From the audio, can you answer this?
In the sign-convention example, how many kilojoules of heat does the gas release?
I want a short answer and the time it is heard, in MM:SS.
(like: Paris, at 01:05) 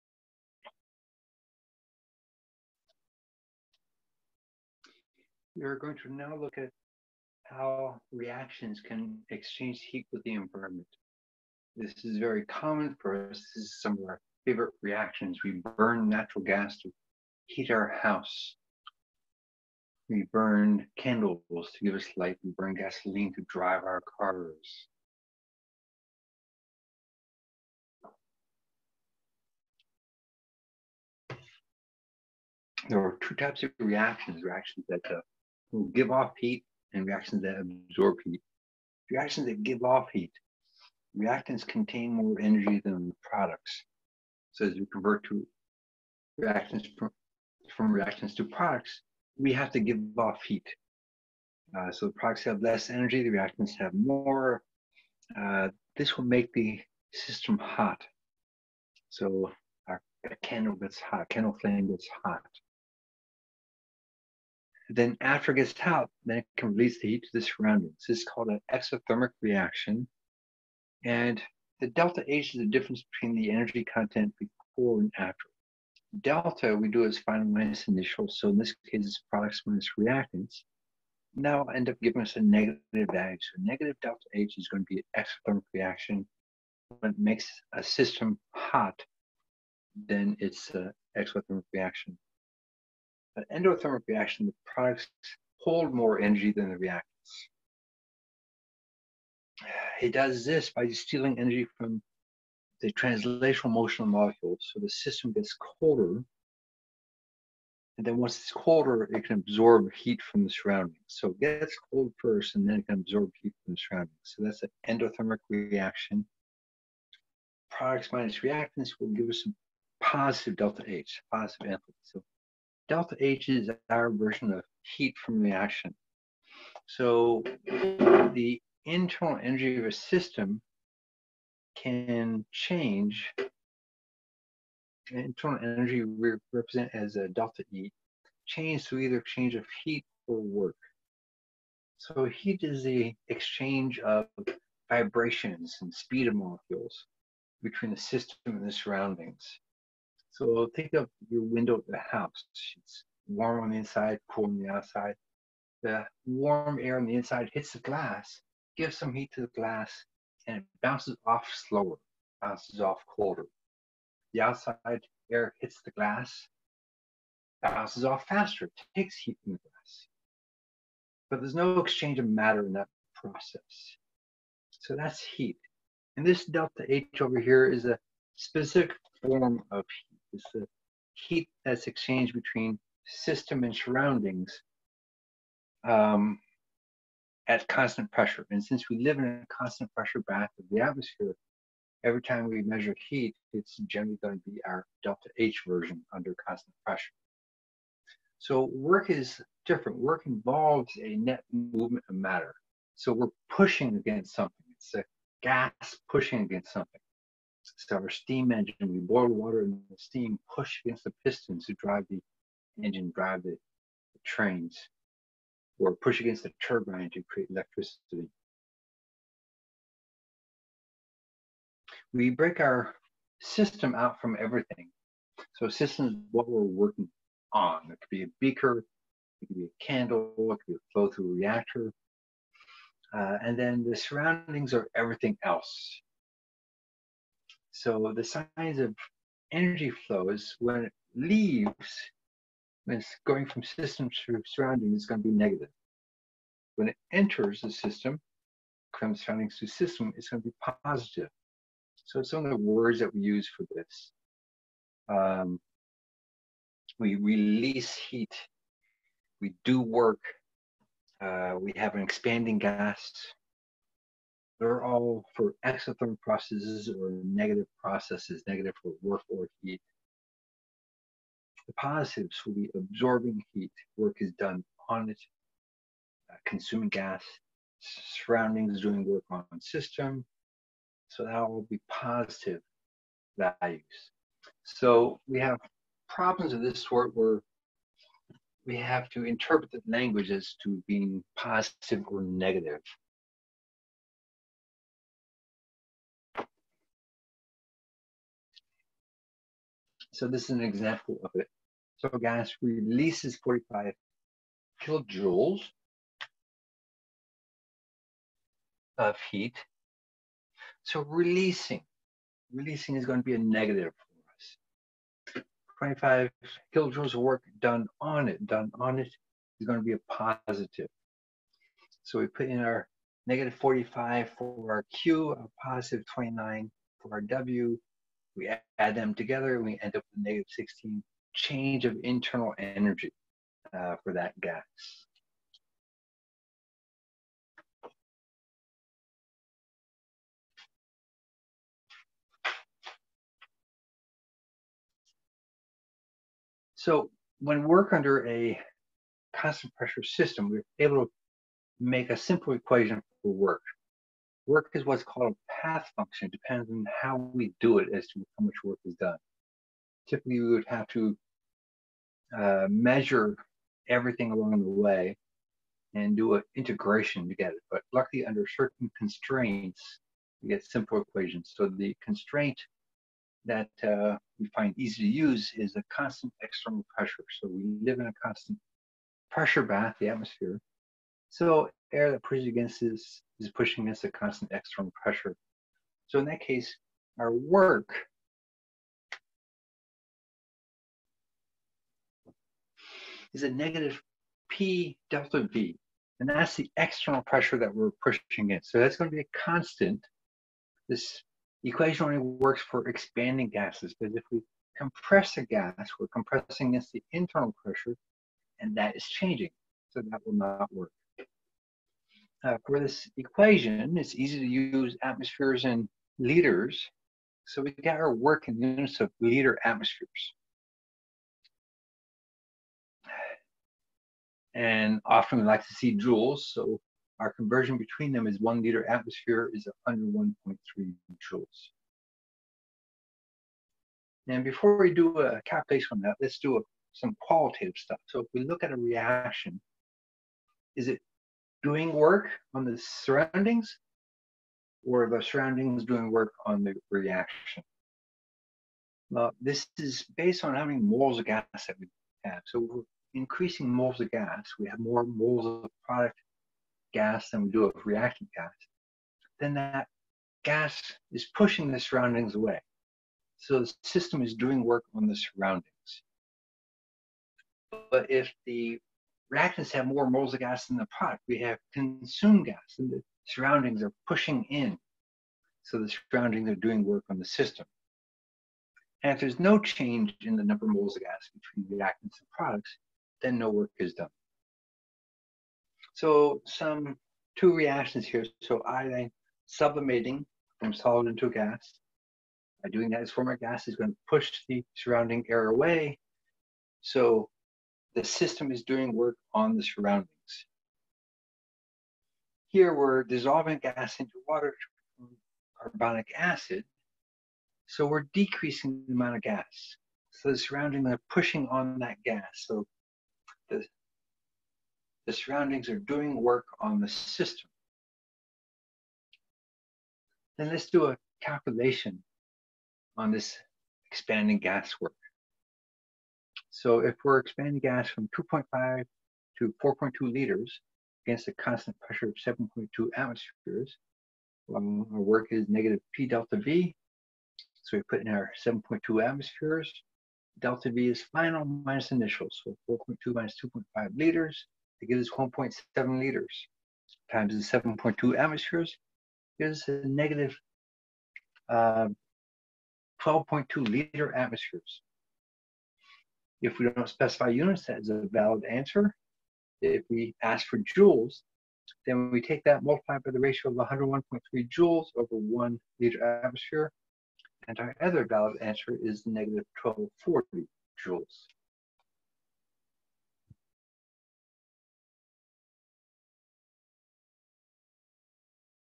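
45 kilojoules, at 05:03.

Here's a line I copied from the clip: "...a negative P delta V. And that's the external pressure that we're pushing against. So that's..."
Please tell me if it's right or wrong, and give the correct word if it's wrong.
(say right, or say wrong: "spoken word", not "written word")
right.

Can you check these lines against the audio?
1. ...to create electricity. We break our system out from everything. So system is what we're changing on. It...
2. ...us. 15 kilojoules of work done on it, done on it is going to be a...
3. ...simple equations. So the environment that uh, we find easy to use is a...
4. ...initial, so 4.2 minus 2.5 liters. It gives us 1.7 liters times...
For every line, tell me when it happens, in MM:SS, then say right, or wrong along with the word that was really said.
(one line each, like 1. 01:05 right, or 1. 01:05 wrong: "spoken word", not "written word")
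1. 03:37 wrong: "working", not "changing"
2. 05:15 wrong: "25", not "15"
3. 06:10 wrong: "constraint", not "environment"
4. 09:01 right.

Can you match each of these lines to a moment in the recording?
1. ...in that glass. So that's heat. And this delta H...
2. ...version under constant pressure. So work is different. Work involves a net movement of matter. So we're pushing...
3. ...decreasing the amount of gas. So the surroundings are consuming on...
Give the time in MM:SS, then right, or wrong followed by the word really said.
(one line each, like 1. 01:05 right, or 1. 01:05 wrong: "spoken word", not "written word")
1. 02:52 wrong: "process", not "glass"
2. 03:15 right
3. 08:28 wrong: "pushing", not "consuming".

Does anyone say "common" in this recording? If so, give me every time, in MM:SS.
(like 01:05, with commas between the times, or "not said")
00:12.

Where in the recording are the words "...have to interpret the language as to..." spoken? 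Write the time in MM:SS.
04:48.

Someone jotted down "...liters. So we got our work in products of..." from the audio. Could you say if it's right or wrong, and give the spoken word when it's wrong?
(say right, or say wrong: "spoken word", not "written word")
wrong: "units", not "products".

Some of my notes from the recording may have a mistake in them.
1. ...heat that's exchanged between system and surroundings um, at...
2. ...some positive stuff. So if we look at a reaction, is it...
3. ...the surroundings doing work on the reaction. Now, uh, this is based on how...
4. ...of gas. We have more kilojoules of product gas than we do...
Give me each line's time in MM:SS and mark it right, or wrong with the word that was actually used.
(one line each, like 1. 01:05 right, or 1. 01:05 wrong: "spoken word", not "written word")
1. 03:01 right
2. 07:16 wrong: "qualitative", not "positive"
3. 07:25 right
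4. 07:33 wrong: "moles", not "kilojoules".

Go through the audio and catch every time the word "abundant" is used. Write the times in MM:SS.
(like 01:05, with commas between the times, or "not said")
not said.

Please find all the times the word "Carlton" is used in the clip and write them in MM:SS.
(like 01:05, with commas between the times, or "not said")
not said.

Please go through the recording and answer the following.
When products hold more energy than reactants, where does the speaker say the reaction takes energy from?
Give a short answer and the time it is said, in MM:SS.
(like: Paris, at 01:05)
translational motion of molecules, at 01:42.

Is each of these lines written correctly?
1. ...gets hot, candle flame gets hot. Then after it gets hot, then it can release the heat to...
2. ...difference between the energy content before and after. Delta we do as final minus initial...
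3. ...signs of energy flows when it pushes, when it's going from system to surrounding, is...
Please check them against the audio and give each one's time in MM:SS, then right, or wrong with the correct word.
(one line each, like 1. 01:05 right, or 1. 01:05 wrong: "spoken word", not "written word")
1. 01:00 right
2. 01:12 right
3. 03:58 wrong: "leaves", not "pushes".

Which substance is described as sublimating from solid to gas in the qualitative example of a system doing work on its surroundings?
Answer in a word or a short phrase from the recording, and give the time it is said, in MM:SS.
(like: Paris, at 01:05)
iodine, at 08:08.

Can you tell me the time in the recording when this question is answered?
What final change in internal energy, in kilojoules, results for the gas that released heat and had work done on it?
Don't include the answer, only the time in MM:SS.
05:30.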